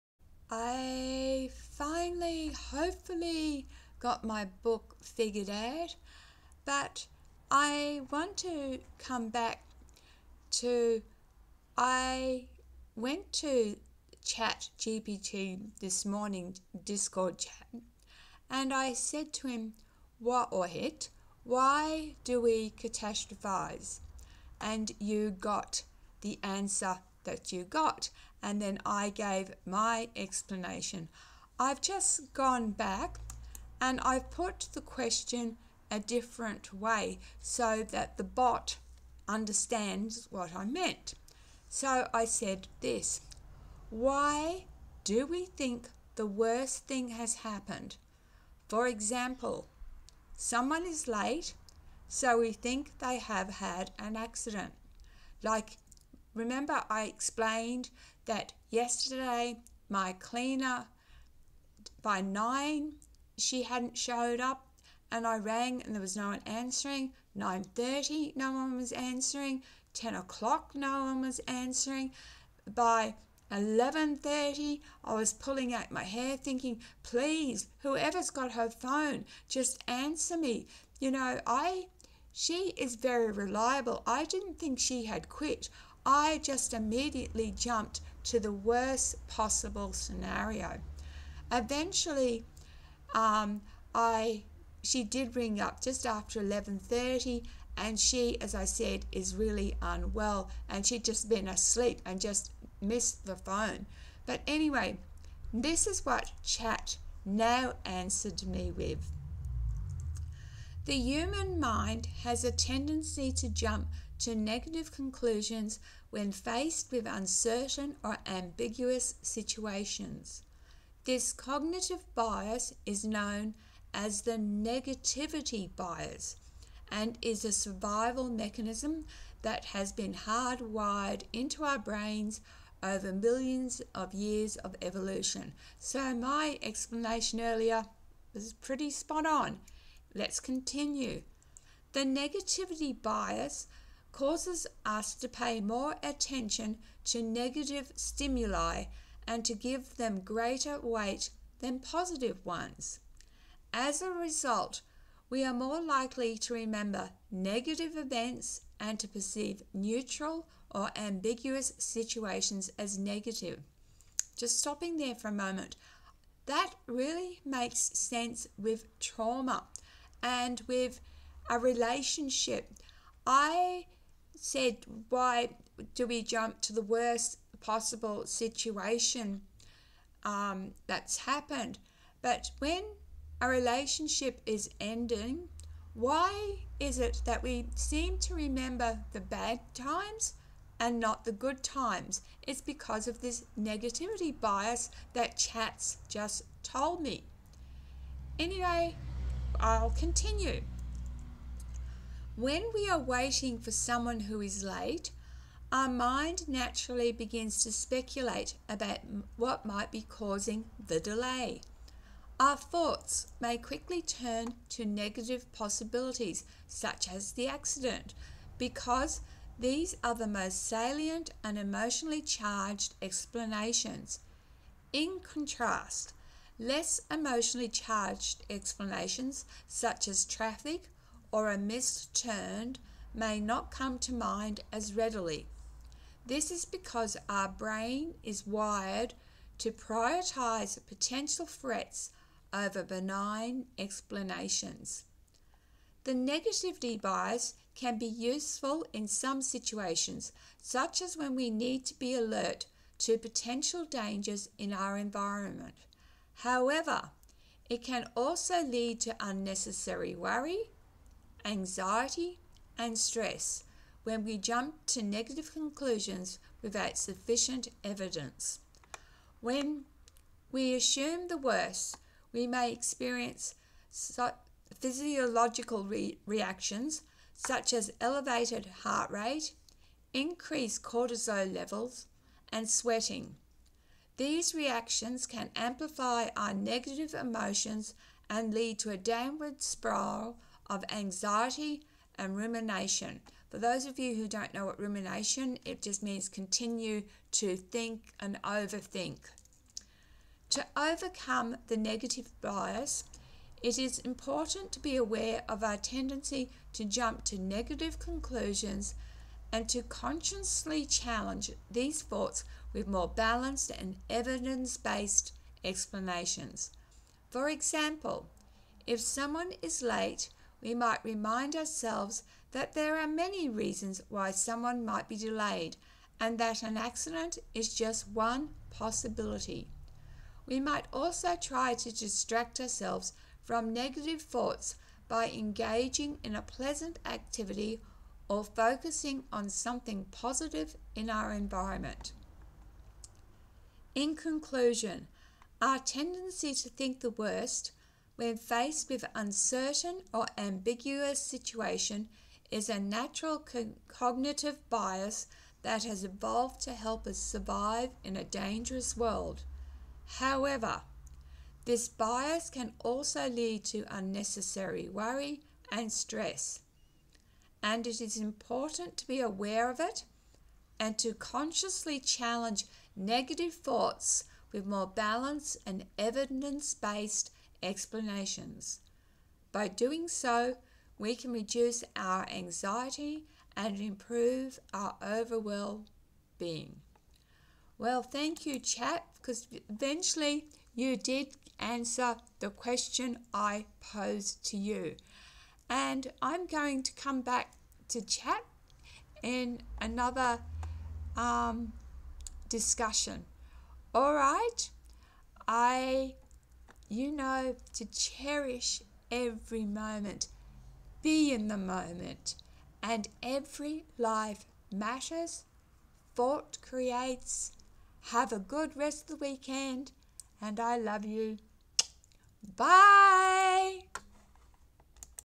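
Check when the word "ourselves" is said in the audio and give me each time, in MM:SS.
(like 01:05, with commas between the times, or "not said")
05:21, 05:32.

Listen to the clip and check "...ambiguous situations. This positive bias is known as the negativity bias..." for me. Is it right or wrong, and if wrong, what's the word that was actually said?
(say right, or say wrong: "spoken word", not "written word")
wrong: "cognitive", not "positive".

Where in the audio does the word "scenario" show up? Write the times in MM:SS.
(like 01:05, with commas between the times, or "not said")
01:29.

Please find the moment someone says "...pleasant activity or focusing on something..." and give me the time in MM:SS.
05:36.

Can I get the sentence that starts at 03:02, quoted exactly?
But when a relationship is ending, why is it that we seem to remember the bad times and not the good times?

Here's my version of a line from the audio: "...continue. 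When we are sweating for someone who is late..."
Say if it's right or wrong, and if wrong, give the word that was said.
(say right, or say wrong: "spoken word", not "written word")
wrong: "waiting", not "sweating".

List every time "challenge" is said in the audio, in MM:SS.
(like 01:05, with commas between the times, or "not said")
05:10, 06:11.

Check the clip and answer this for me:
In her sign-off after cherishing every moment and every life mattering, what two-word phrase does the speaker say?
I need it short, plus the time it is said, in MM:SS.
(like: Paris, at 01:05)
Thought creates, at 06:56.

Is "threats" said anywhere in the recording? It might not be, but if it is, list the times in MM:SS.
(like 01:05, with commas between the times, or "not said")
04:01.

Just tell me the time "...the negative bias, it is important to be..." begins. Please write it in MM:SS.
05:01.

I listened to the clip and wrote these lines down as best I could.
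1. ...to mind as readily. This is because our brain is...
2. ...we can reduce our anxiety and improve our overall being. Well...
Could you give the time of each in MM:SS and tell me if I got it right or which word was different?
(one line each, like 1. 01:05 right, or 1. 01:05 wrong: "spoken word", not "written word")
1. 03:53 right
2. 06:20 right.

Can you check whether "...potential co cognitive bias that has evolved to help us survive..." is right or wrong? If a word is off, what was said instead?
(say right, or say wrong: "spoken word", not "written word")
wrong: "natural", not "potential".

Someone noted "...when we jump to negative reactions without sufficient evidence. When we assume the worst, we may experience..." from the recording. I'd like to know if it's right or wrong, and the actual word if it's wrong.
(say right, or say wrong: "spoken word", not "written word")
wrong: "conclusions", not "reactions".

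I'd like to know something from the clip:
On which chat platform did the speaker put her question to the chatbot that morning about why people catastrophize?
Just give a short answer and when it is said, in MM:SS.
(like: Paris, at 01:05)
Discord, at 00:16.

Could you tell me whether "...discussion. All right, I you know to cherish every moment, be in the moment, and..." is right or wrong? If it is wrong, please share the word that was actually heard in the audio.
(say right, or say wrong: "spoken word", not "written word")
right.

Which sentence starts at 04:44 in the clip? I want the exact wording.
These reactions can amplify our negative emotions and lead to a downward spiral of anxiety and rumination.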